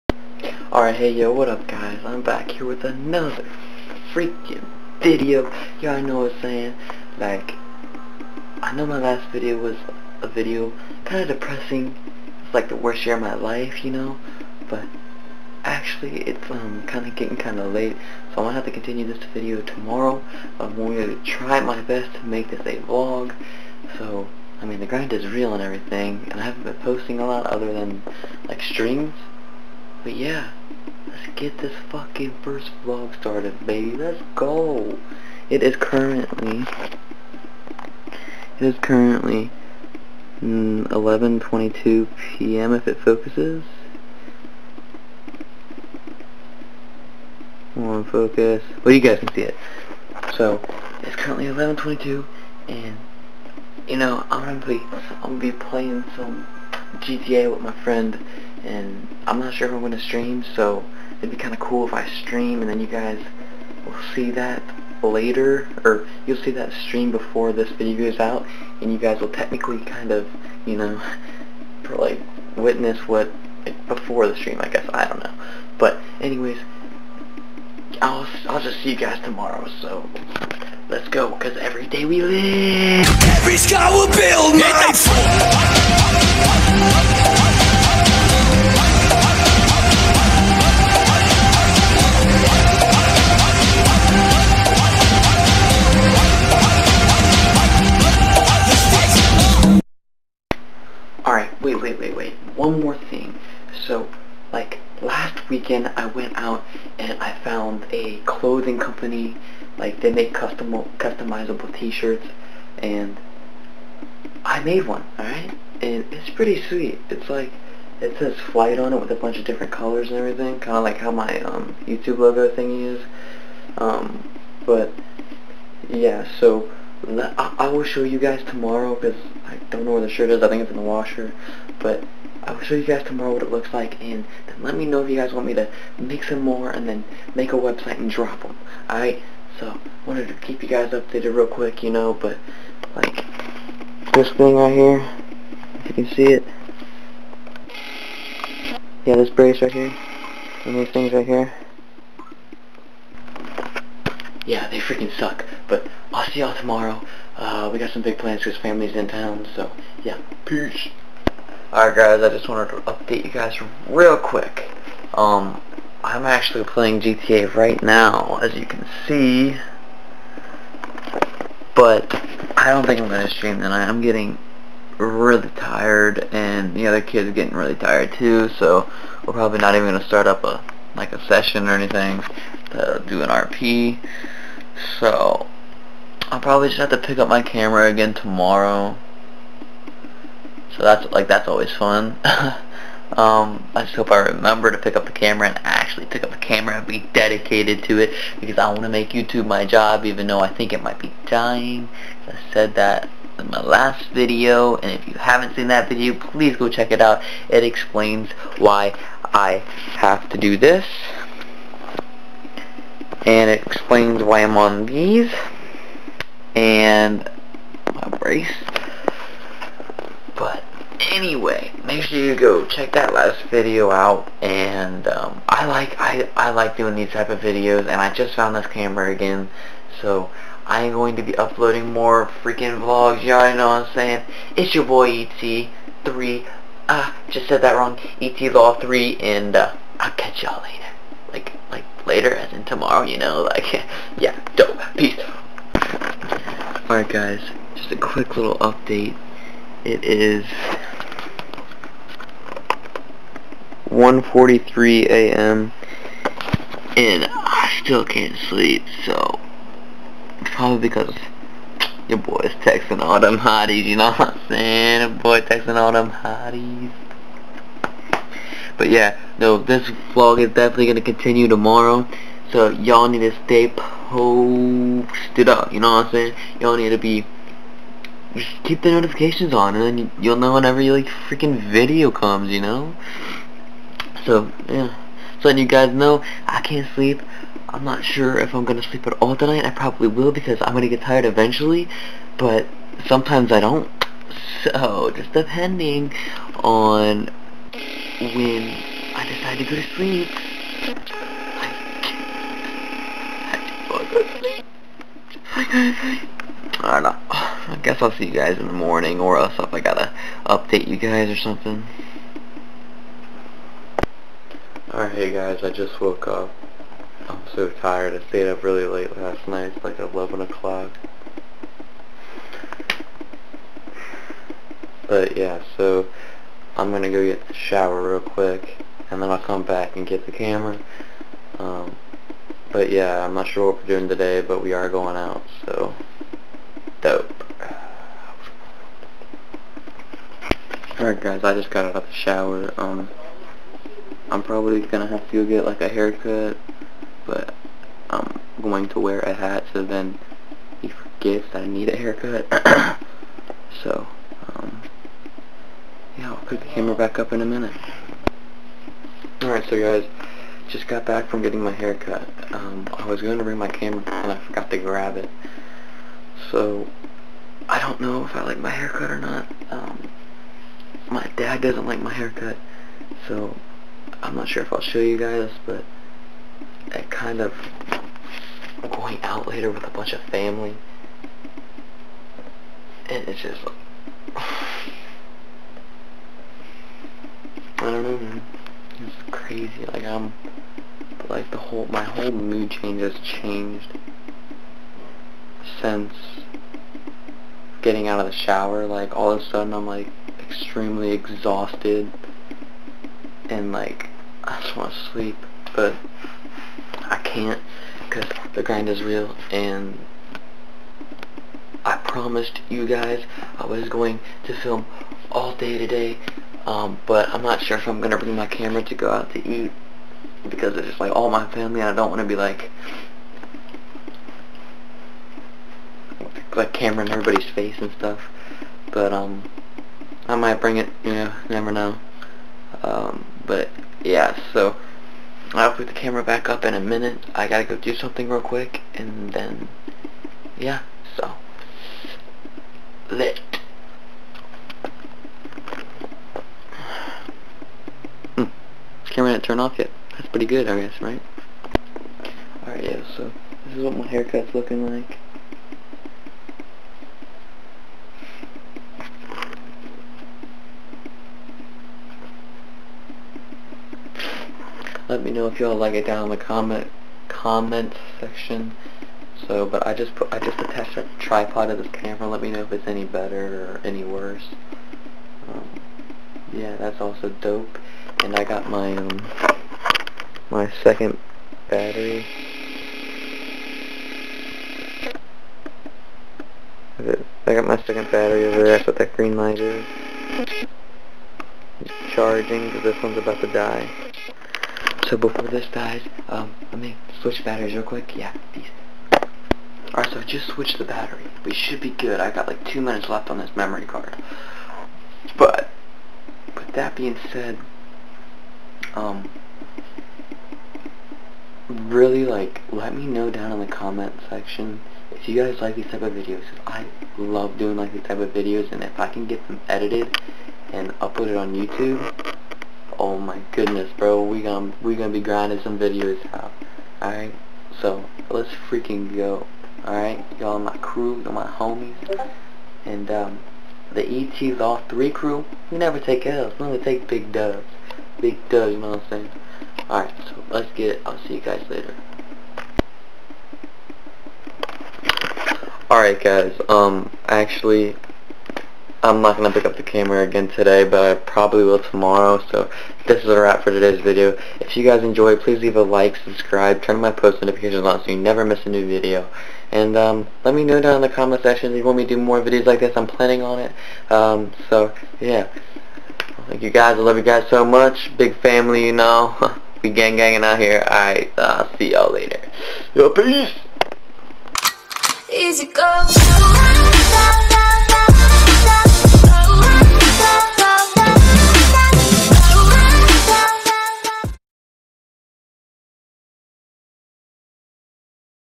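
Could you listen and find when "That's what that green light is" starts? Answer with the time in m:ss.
8:08.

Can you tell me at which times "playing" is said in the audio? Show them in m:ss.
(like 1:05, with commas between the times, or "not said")
0:55, 2:46.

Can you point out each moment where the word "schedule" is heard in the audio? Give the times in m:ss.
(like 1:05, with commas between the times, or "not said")
not said.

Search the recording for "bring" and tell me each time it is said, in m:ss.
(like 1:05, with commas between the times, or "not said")
6:03, 6:58, 7:10.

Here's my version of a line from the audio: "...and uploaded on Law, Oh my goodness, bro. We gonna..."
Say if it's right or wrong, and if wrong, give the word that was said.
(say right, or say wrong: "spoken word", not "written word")
wrong: "YouTube", not "Law".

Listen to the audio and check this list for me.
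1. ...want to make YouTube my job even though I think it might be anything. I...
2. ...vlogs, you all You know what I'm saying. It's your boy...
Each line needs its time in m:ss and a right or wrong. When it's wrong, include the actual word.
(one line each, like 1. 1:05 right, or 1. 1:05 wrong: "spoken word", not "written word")
1. 3:18 wrong: "dying", not "anything"
2. 3:52 right.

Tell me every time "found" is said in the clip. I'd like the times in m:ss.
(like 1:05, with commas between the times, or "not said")
1:47, 3:48.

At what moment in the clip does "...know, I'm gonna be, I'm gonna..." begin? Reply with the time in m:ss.
0:53.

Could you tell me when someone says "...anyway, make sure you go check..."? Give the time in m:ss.
3:41.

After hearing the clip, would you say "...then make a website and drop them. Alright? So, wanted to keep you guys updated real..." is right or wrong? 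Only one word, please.
right.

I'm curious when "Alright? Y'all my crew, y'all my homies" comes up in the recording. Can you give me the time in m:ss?
8:49.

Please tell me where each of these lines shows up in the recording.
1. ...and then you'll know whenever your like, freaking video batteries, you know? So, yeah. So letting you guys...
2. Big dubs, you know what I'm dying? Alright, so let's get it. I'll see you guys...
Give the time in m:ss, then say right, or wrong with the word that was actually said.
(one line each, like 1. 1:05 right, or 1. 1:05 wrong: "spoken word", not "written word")
1. 4:39 wrong: "comes", not "batteries"
2. 8:58 wrong: "saying", not "dying".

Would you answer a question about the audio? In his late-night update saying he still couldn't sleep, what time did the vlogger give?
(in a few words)
1:43 a.m.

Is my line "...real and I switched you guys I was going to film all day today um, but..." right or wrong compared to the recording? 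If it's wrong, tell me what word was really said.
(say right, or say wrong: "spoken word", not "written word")
wrong: "promised", not "switched".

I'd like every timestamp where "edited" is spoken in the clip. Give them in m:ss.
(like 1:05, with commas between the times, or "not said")
8:39.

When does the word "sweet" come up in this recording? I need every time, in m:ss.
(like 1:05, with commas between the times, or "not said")
1:56.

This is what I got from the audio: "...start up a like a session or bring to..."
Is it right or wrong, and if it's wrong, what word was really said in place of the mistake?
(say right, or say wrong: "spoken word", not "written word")
wrong: "anything", not "bring".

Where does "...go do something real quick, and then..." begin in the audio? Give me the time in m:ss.
7:17.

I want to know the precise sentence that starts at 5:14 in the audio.
Alright, hey guys, I just woke up so tired.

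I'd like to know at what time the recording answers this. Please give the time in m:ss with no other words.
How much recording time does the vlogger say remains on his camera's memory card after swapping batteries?
8:22.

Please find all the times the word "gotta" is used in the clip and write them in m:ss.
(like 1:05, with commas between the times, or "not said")
5:09, 7:17.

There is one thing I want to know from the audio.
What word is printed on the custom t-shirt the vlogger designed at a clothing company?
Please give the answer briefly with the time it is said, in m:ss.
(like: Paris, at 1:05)
flight, at 1:58.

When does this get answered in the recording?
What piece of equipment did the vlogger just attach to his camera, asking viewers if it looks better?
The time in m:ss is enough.
7:51.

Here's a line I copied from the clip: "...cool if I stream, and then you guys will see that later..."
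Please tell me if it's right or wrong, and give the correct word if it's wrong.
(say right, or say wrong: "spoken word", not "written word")
right.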